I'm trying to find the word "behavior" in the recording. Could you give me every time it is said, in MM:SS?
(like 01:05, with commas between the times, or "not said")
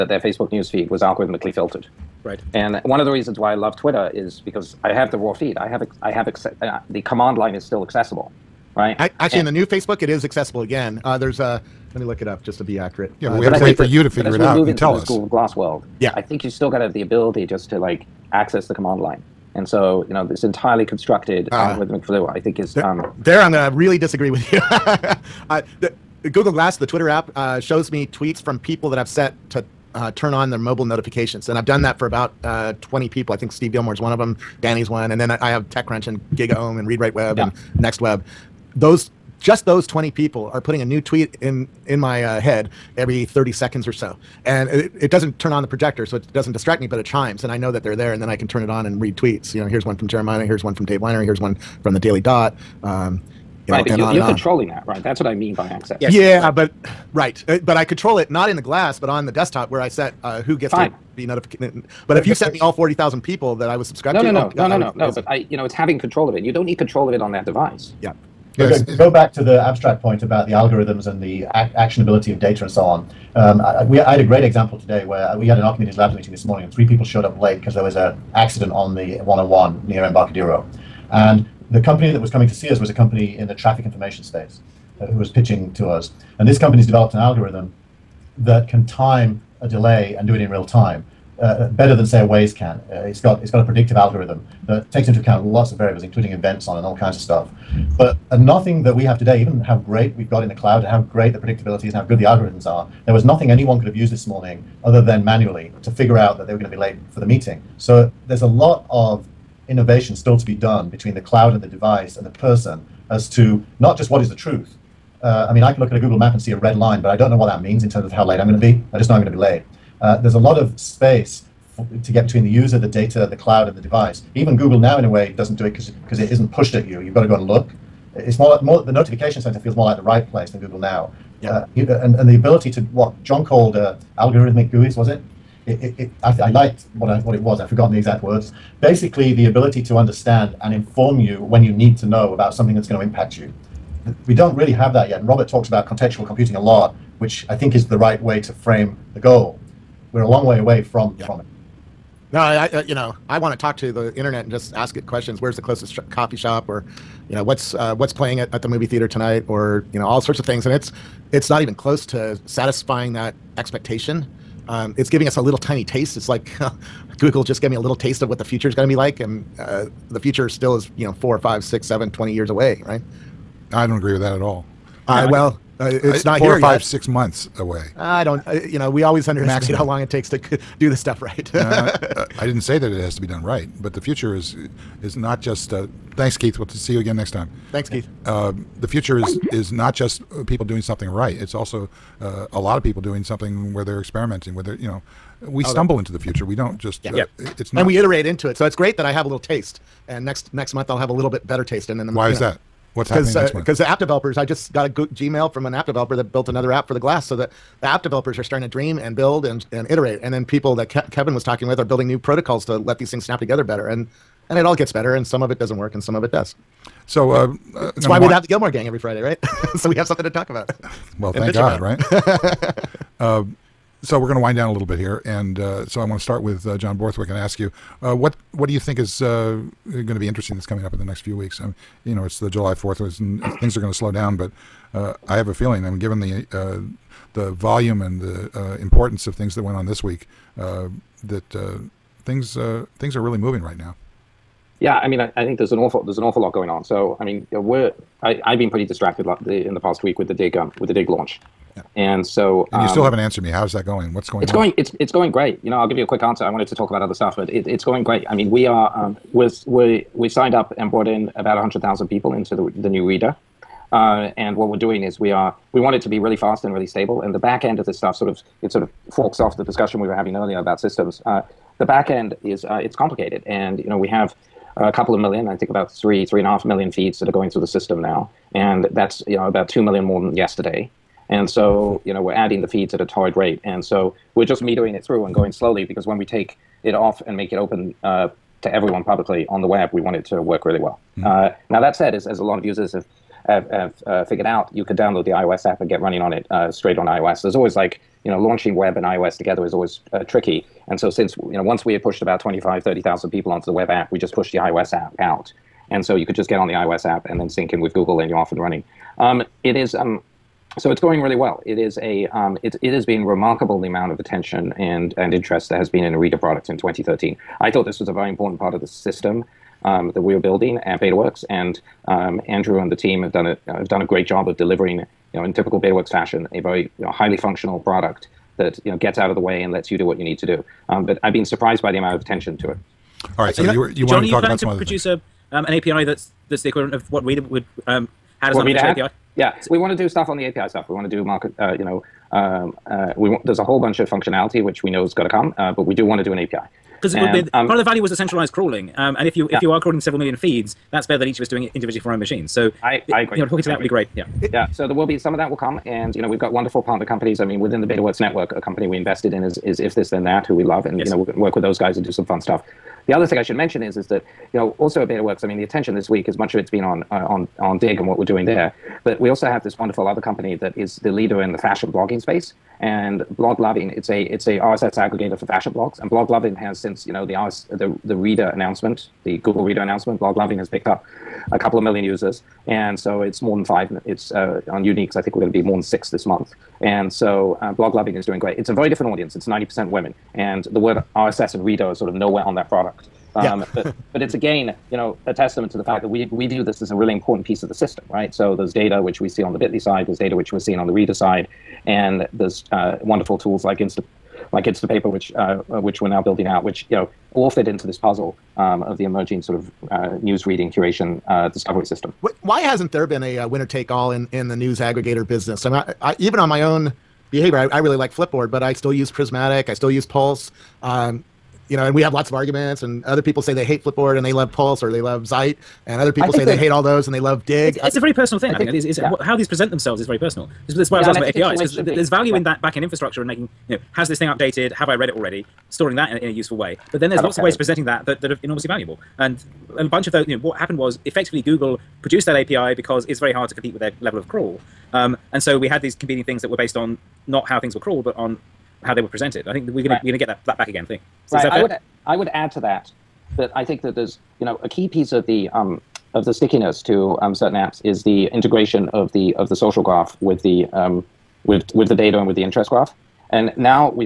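06:57.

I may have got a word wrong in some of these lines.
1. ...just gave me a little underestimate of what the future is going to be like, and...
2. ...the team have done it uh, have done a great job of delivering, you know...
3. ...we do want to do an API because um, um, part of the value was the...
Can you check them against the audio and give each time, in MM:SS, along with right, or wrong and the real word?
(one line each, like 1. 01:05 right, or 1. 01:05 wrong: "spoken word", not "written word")
1. 02:47 wrong: "taste", not "underestimate"
2. 05:22 right
3. 05:45 right.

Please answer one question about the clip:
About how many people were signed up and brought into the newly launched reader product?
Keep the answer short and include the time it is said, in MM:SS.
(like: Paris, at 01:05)
100,000, at 04:21.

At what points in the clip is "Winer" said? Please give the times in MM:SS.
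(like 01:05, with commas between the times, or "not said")
00:50.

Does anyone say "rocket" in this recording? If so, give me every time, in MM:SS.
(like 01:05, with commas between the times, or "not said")
not said.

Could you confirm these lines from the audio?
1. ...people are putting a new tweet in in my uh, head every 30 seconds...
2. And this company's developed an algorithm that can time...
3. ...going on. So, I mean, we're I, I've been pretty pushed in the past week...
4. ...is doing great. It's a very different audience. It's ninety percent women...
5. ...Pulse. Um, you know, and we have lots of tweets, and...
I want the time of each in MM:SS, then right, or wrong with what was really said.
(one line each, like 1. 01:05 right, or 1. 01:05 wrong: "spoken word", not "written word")
1. 00:40 right
2. 01:26 right
3. 04:06 wrong: "distracted", not "pushed"
4. 06:28 right
5. 07:00 wrong: "arguments", not "tweets".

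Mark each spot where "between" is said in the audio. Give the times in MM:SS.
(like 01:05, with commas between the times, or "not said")
01:50, 02:02.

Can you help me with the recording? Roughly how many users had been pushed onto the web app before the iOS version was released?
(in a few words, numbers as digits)
25,000 to 30,000.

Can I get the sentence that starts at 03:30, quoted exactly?
And then people that Ke- Kevin was talking with are building new protocols to let these things snap together better.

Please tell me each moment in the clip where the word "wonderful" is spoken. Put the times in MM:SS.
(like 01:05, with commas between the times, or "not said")
05:56, 06:09, 06:42.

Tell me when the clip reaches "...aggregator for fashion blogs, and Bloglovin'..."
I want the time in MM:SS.
06:15.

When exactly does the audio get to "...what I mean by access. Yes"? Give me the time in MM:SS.
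00:55.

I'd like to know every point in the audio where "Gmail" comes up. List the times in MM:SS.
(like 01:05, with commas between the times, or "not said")
03:24.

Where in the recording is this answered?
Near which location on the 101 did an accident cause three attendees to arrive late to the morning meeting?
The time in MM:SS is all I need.
01:20.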